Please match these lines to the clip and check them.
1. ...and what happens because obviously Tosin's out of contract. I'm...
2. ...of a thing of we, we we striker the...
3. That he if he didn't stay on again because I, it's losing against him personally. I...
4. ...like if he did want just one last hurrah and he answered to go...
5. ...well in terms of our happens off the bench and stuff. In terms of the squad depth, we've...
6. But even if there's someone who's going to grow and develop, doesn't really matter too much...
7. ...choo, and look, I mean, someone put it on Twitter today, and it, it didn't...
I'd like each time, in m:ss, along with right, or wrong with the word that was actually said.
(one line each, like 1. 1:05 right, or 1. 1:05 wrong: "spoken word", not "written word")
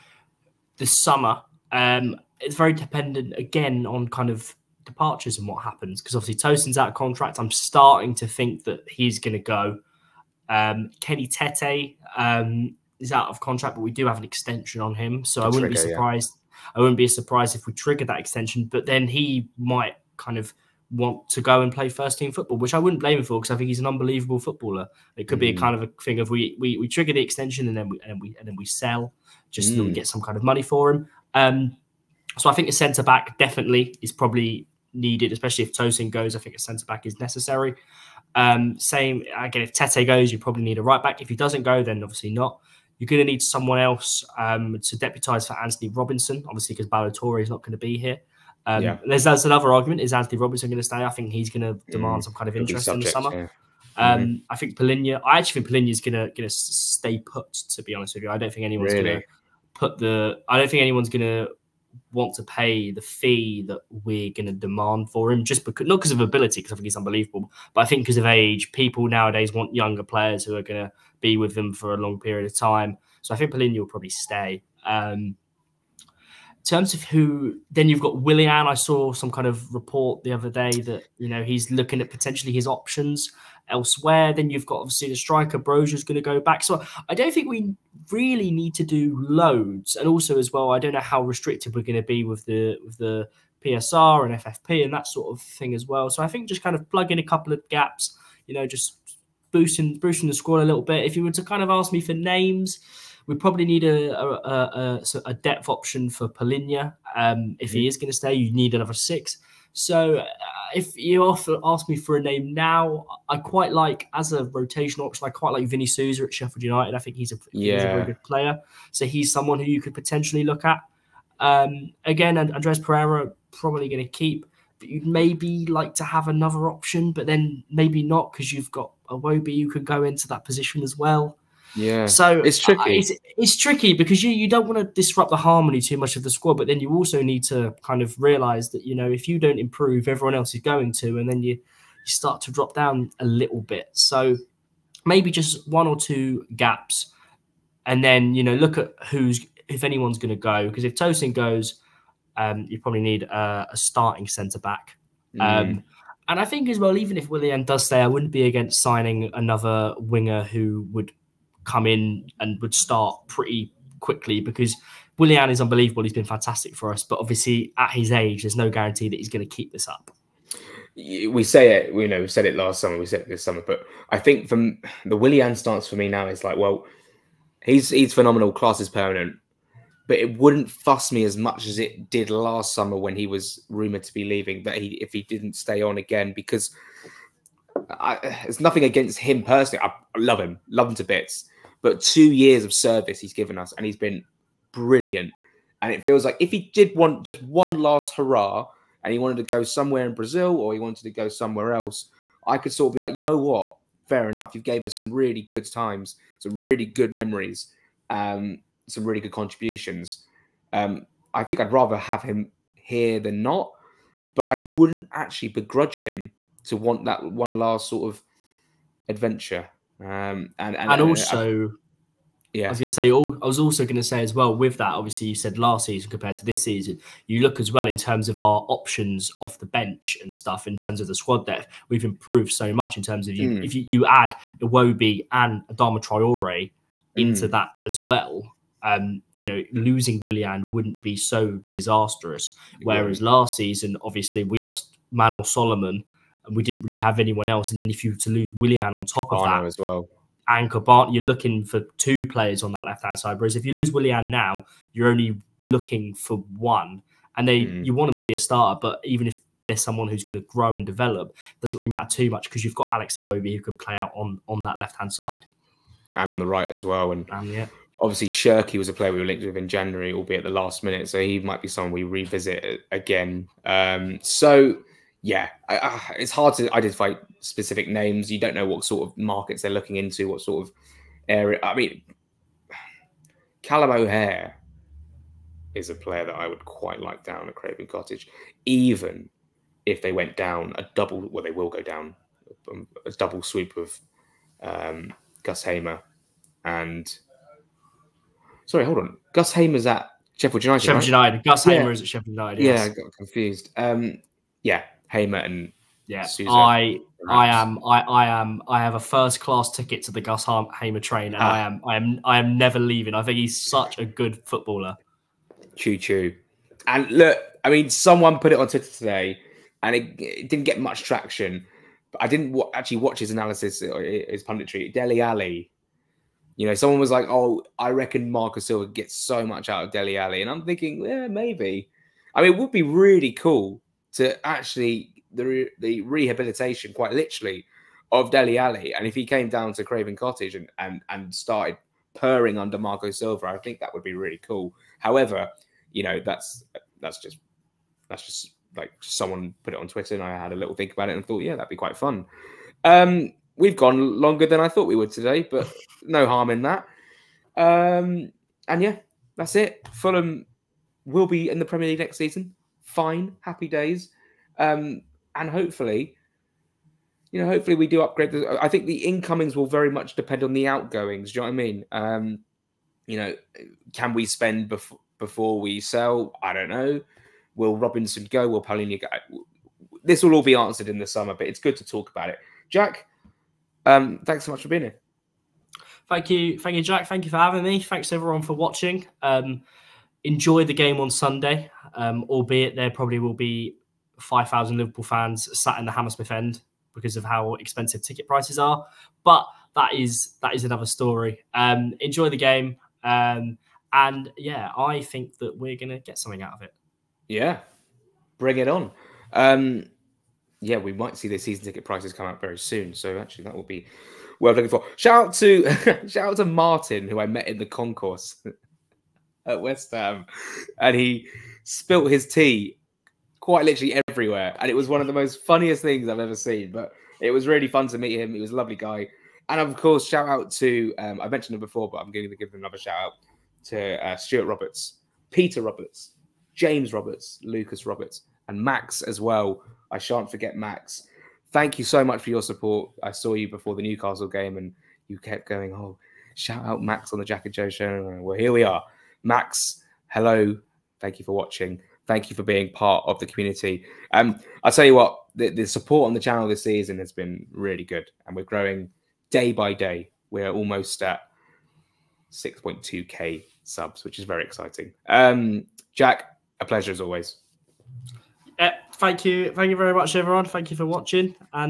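1. 0:05 right
2. 0:25 wrong: "trigger", not "striker"
3. 3:04 wrong: "nothing", not "losing"
4. 3:16 wrong: "wanted", not "answered"
5. 3:47 wrong: "options", not "happens"
6. 4:18 right
7. 5:15 right.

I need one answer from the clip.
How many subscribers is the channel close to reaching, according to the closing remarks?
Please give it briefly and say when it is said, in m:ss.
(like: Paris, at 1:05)
6.2k, at 7:42.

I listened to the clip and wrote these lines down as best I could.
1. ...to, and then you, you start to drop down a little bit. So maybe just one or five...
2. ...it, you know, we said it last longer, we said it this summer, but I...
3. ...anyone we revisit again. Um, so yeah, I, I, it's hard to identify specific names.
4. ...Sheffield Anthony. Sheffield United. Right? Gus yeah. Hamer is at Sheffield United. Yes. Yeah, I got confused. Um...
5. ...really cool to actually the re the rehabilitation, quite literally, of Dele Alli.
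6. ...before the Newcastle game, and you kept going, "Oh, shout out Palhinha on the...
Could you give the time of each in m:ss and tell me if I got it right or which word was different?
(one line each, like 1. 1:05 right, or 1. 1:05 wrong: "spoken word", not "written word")
1. 2:20 wrong: "two", not "five"
2. 2:51 wrong: "summer", not "longer"
3. 4:31 wrong: "someone", not "anyone"
4. 5:00 wrong: "United", not "Anthony"
5. 5:32 right
6. 7:23 wrong: "Max", not "Palhinha".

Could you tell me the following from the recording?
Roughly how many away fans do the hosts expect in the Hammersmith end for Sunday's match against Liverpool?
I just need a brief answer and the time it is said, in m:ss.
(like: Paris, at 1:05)
5,000, at 6:34.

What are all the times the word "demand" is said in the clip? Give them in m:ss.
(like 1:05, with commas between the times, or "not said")
0:51, 1:04.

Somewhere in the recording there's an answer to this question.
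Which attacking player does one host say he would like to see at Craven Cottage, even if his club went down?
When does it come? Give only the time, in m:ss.
4:43.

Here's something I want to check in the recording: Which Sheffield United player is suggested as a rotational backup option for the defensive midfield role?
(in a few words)
Vini Souza.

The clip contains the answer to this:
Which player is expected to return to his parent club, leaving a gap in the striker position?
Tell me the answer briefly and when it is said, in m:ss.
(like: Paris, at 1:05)
Broja, at 1:25.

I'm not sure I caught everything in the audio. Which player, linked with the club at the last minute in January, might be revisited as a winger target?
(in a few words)
Shirky.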